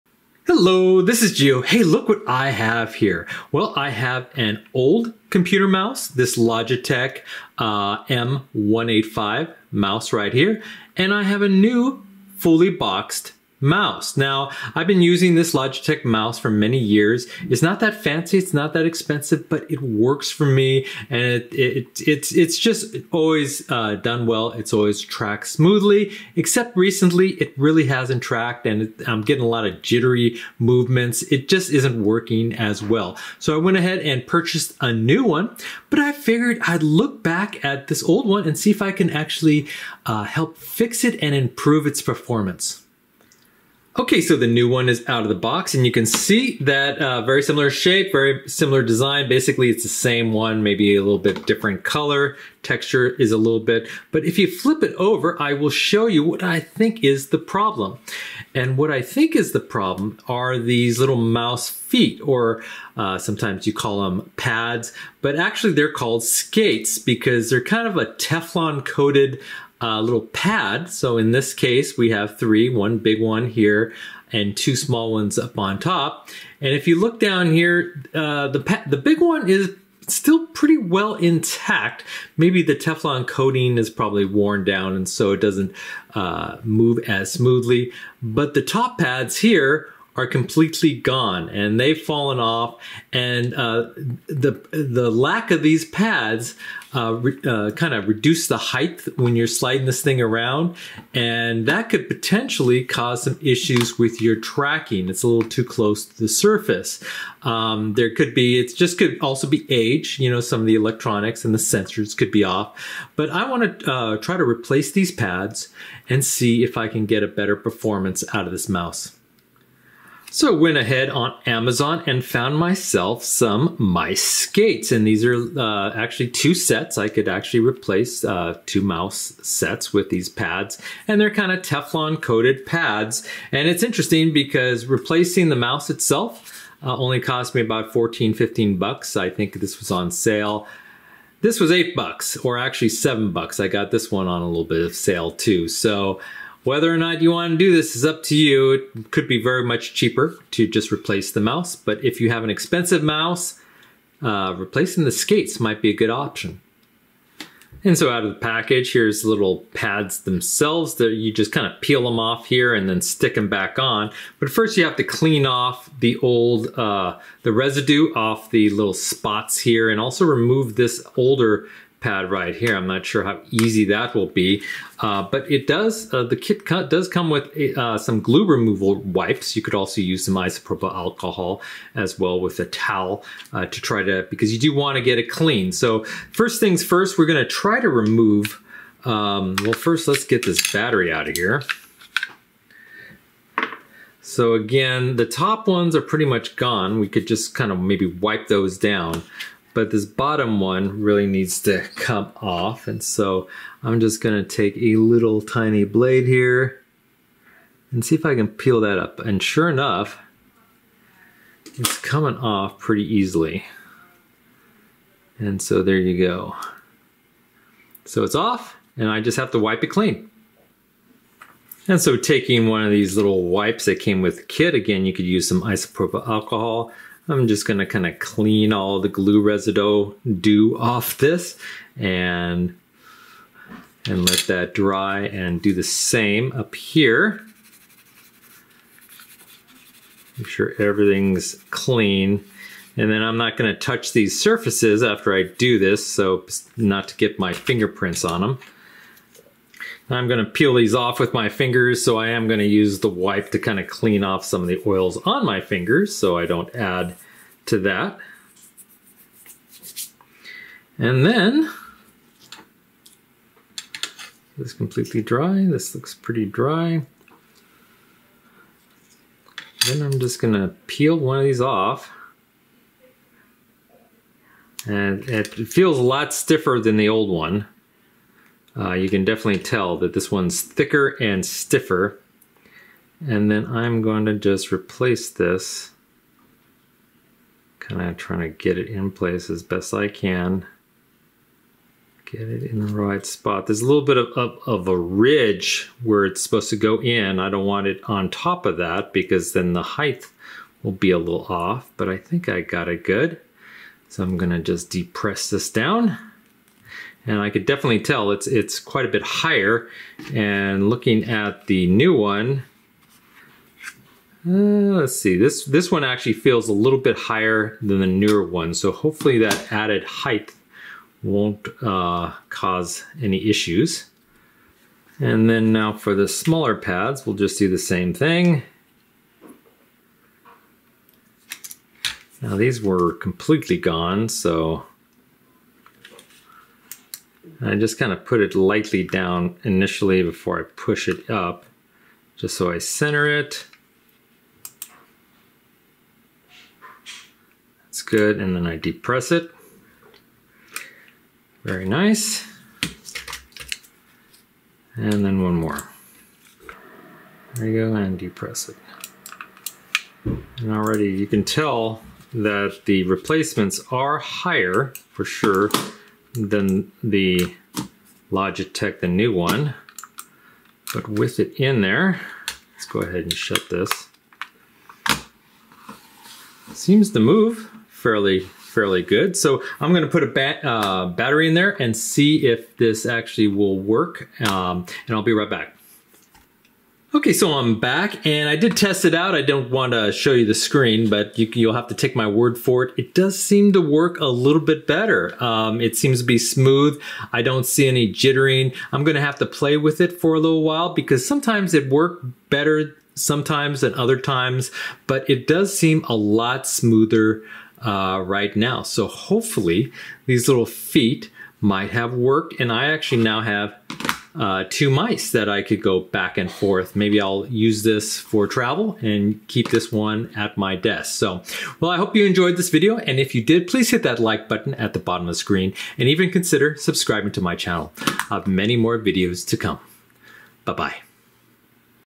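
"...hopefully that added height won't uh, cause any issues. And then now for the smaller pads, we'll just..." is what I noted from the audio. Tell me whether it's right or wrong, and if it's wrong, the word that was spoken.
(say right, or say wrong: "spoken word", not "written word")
right.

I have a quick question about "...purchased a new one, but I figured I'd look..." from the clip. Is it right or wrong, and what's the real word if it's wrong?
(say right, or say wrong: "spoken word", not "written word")
right.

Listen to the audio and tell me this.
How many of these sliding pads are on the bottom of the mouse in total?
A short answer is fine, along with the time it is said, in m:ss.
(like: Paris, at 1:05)
3, at 1:12.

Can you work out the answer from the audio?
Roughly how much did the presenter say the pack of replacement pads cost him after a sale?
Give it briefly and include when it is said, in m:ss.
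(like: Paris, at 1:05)
7 dollars, at 2:22.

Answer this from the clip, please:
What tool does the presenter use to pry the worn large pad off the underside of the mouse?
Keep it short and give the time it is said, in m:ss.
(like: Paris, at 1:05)
tiny blade, at 3:25.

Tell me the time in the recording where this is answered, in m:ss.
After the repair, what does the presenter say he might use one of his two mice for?
6:58.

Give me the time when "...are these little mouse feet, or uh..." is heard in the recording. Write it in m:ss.
1:00.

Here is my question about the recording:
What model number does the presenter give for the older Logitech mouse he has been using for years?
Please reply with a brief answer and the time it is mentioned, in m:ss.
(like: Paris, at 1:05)
M185, at 0:08.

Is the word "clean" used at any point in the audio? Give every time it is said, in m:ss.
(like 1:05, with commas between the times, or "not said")
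2:45, 3:05, 3:39, 3:48, 4:01, 4:13.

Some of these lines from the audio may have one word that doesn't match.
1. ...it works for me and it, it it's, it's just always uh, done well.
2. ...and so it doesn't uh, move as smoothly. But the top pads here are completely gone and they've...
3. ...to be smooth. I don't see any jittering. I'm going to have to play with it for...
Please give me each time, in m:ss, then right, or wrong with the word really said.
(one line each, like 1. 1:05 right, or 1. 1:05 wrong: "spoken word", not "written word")
1. 0:19 right
2. 1:24 right
3. 6:36 right.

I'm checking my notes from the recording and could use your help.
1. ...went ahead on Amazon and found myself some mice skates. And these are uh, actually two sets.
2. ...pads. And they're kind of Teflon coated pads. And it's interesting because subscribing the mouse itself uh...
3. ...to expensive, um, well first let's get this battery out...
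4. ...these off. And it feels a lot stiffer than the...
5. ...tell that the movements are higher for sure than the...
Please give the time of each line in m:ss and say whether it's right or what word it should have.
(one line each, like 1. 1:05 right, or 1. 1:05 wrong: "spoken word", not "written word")
1. 2:00 right
2. 2:10 wrong: "replacing", not "subscribing"
3. 3:07 wrong: "remove", not "expensive"
4. 4:31 right
5. 6:01 wrong: "replacements", not "movements".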